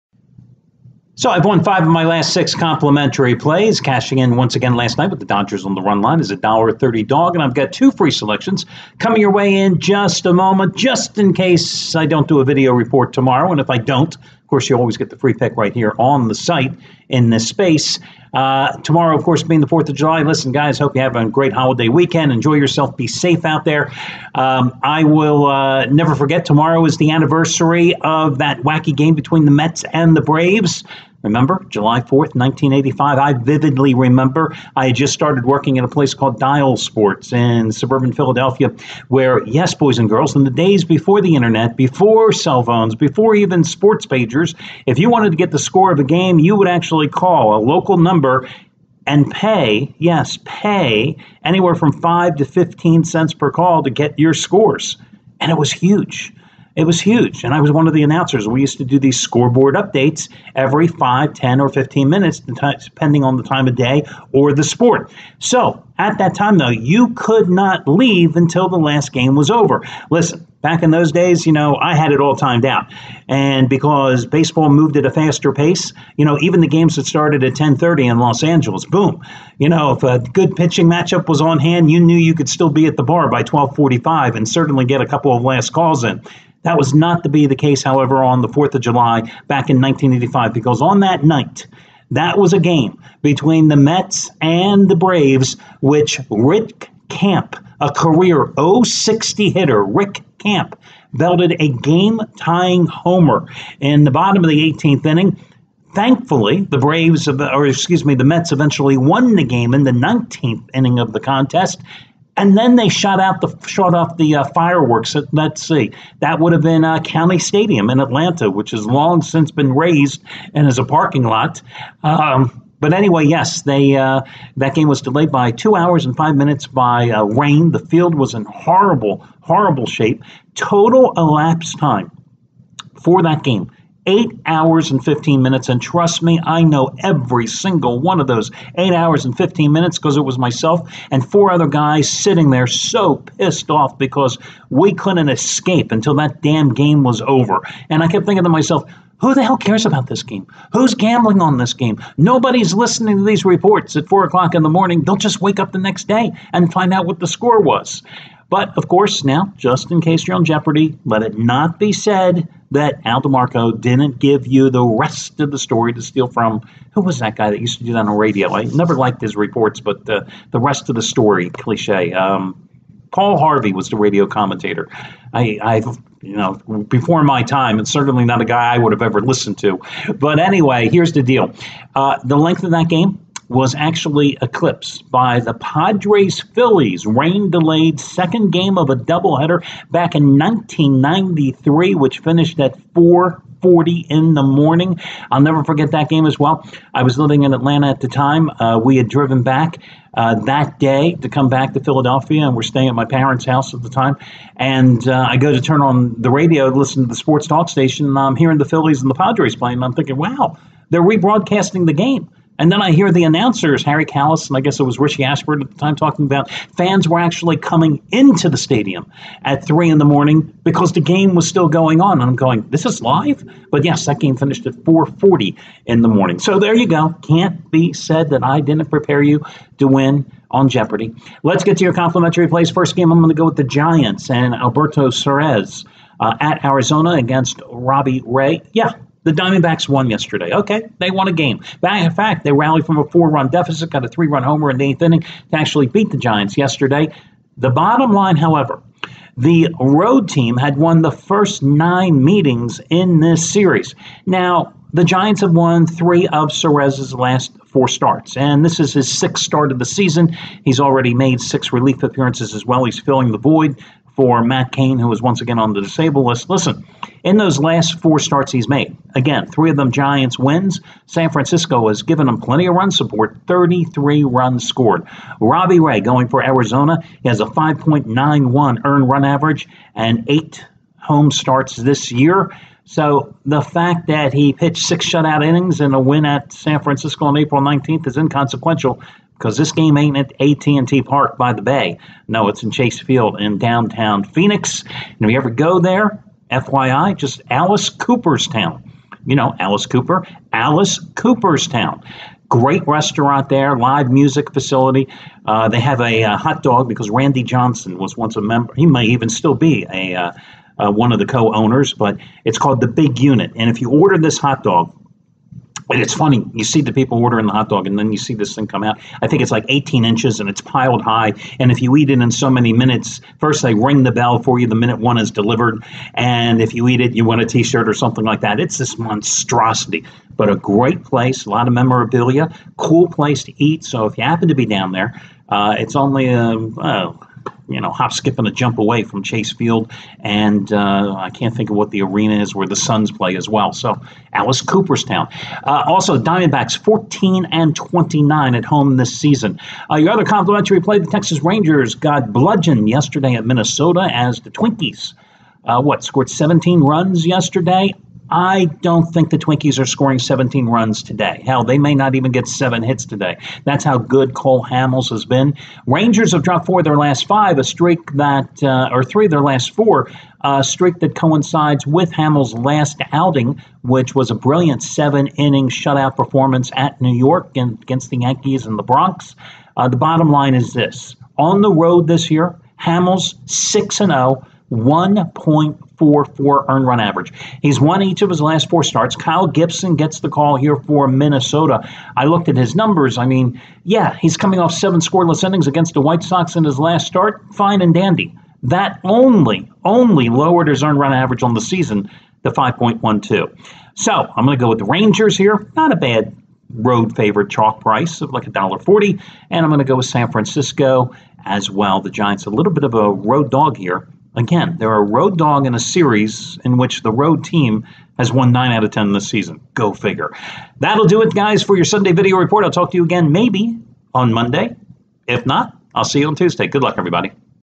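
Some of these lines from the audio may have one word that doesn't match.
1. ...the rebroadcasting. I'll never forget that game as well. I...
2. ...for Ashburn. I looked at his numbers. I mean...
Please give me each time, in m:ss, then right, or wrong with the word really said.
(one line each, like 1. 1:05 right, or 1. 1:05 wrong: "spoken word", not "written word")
1. 3:14 wrong: "morning", not "rebroadcasting"
2. 6:30 wrong: "Minnesota", not "Ashburn".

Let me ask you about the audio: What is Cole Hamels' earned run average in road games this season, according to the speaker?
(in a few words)
1.44.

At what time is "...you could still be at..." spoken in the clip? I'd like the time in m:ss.
1:22.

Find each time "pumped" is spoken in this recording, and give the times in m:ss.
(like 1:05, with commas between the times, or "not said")
not said.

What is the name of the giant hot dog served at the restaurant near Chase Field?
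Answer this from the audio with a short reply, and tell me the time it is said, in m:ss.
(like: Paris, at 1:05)
The Big Unit, at 5:12.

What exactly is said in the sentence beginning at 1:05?
So at that time, though, you could not leave until the last game was over.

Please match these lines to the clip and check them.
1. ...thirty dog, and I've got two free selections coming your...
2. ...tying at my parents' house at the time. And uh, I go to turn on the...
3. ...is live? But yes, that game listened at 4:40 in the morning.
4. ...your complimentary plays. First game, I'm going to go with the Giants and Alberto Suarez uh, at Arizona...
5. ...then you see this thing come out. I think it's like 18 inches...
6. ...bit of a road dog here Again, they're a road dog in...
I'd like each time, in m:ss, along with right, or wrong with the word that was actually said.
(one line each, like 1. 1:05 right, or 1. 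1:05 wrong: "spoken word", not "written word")
1. 0:06 right
2. 3:22 wrong: "staying", not "tying"
3. 3:42 wrong: "finished", not "listened"
4. 3:51 right
5. 5:17 right
6. 6:52 right.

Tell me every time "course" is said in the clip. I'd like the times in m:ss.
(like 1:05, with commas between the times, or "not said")
0:14, 0:19, 2:38.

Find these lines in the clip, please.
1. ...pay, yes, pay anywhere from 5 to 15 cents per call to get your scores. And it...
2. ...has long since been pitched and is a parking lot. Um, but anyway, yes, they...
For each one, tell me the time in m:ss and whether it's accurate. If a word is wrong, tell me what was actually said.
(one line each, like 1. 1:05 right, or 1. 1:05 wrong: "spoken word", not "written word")
1. 0:49 right
2. 1:58 wrong: "razed", not "pitched".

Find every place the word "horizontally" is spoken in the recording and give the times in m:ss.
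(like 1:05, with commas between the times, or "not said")
not said.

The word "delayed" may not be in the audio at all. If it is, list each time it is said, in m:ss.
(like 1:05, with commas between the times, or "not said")
2:05, 3:07.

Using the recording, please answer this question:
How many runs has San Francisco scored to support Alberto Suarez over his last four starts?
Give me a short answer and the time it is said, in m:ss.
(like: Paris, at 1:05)
33, at 4:33.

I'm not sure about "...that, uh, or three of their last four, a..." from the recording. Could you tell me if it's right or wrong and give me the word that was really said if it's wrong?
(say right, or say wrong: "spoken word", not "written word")
right.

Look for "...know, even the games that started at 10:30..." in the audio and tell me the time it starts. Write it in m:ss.
1:16.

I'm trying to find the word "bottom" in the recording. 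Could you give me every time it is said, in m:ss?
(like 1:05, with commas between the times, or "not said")
1:44, 4:07, 6:19.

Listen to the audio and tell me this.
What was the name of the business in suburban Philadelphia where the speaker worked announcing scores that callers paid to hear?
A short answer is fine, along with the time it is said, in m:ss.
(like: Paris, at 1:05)
Dial Sports, at 0:36.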